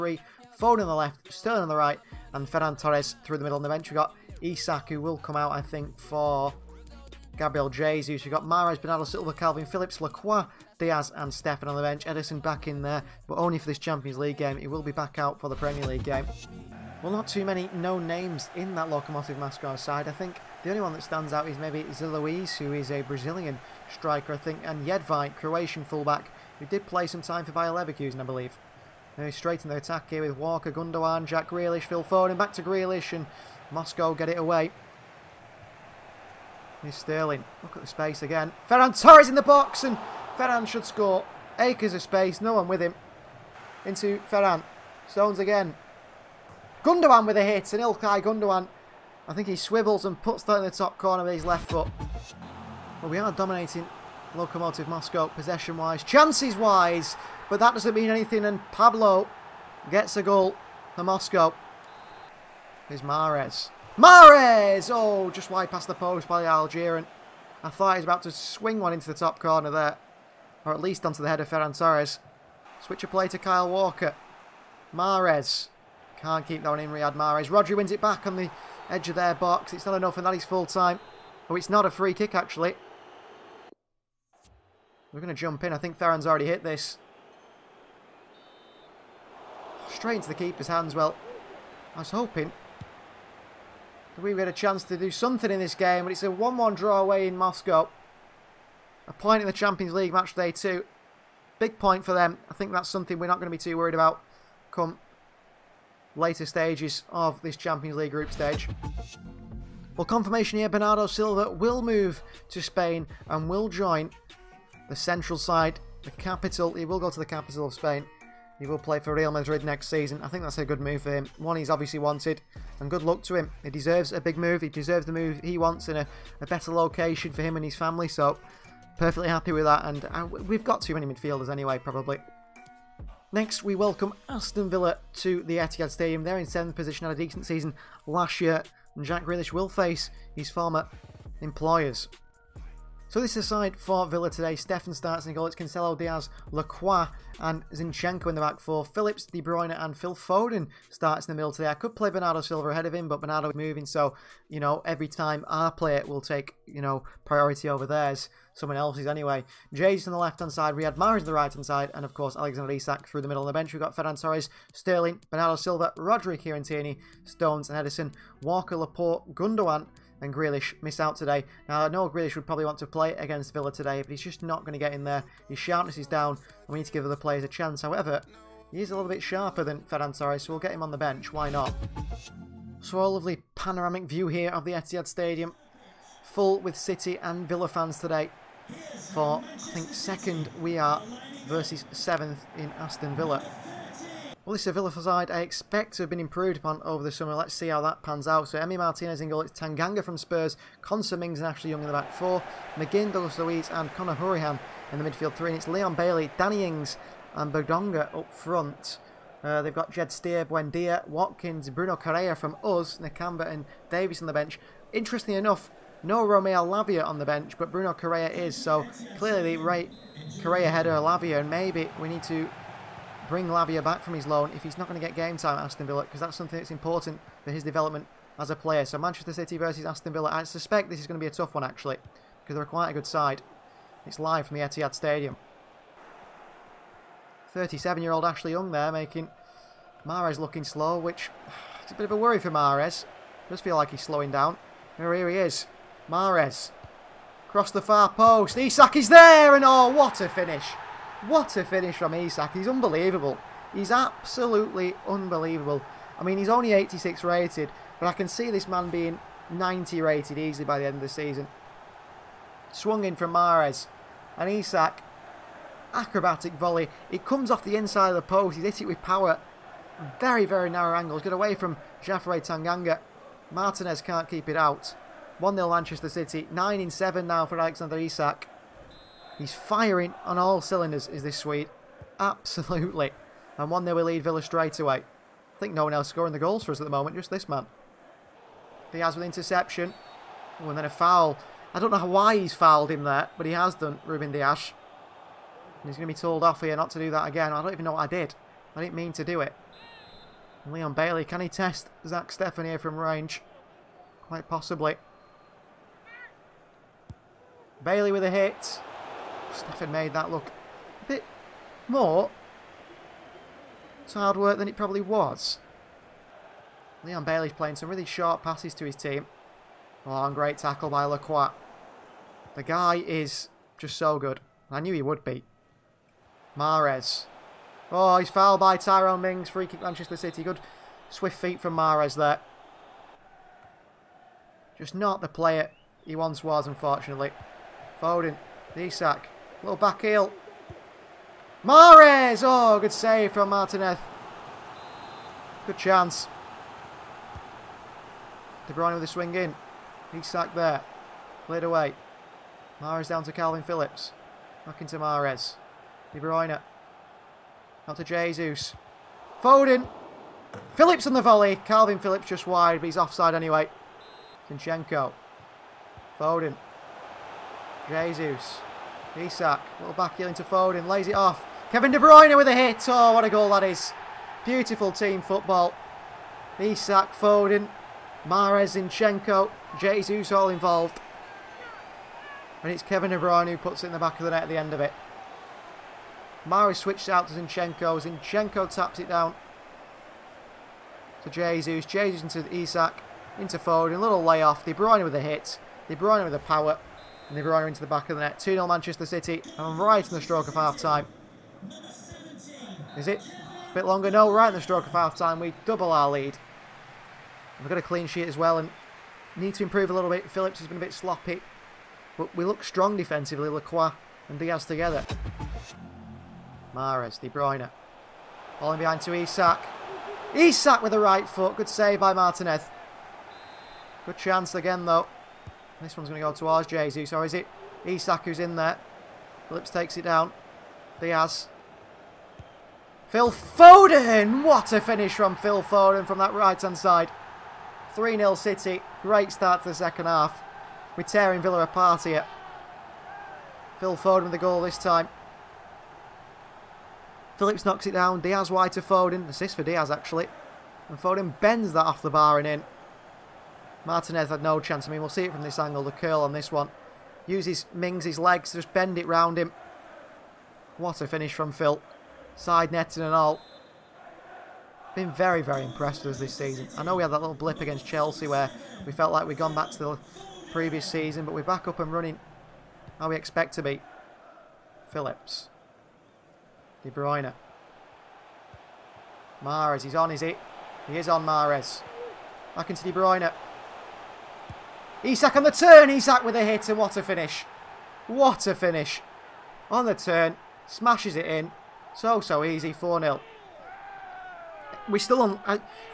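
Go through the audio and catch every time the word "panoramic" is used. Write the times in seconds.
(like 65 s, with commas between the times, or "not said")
183 s.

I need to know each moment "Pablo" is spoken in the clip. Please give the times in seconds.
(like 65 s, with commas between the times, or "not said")
58 s.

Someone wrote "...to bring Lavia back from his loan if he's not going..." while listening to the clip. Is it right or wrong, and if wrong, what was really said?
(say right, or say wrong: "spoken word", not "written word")
right.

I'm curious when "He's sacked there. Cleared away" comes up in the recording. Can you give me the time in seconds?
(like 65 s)
350 s.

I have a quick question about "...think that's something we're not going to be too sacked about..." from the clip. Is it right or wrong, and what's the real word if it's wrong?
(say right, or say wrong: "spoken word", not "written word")
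wrong: "worried", not "sacked".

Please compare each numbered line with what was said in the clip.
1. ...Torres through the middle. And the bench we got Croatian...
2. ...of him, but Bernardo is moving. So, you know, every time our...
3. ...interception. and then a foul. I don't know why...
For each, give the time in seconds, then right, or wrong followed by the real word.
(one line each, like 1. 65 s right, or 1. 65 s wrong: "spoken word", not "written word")
1. 2 s wrong: "Isak", not "Croatian"
2. 152 s right
3. 289 s right.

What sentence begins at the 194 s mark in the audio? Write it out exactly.
Well, this is a Villa side I expect to have been improved upon over the summer.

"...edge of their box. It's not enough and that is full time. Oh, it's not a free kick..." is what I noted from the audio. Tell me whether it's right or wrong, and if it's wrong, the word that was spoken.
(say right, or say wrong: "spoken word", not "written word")
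right.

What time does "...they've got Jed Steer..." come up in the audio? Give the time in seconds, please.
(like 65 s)
209 s.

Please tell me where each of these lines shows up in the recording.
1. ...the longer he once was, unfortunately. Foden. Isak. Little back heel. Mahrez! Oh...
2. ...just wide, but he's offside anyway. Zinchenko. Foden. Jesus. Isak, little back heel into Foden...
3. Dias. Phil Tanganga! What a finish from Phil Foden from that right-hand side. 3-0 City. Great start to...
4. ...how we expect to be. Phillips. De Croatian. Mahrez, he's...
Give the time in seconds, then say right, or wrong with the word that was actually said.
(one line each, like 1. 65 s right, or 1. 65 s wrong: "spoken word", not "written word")
1. 335 s wrong: "player", not "longer"
2. 362 s right
3. 430 s wrong: "Foden", not "Tanganga"
4. 472 s wrong: "Bruyne", not "Croatian".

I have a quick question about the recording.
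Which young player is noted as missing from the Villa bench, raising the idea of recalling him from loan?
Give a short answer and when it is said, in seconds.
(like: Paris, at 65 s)
Romeo Lavia, at 216 s.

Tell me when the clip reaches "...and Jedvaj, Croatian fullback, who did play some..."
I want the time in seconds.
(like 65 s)
24 s.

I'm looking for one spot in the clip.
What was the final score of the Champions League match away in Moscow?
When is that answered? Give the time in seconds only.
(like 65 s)
96 s.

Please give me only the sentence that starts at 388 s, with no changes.
Zinchenko taps it down to Jesus.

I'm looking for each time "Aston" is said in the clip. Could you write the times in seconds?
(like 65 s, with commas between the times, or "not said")
134 s, 192 s, 225 s, 229 s.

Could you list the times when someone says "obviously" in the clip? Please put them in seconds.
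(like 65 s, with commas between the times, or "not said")
121 s.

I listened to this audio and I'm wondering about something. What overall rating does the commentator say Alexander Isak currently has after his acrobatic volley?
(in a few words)
86.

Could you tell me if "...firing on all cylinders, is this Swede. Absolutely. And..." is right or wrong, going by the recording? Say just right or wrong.
right.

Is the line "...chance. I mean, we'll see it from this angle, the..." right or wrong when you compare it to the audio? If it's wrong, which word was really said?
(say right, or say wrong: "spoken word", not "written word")
right.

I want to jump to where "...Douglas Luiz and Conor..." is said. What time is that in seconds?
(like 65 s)
203 s.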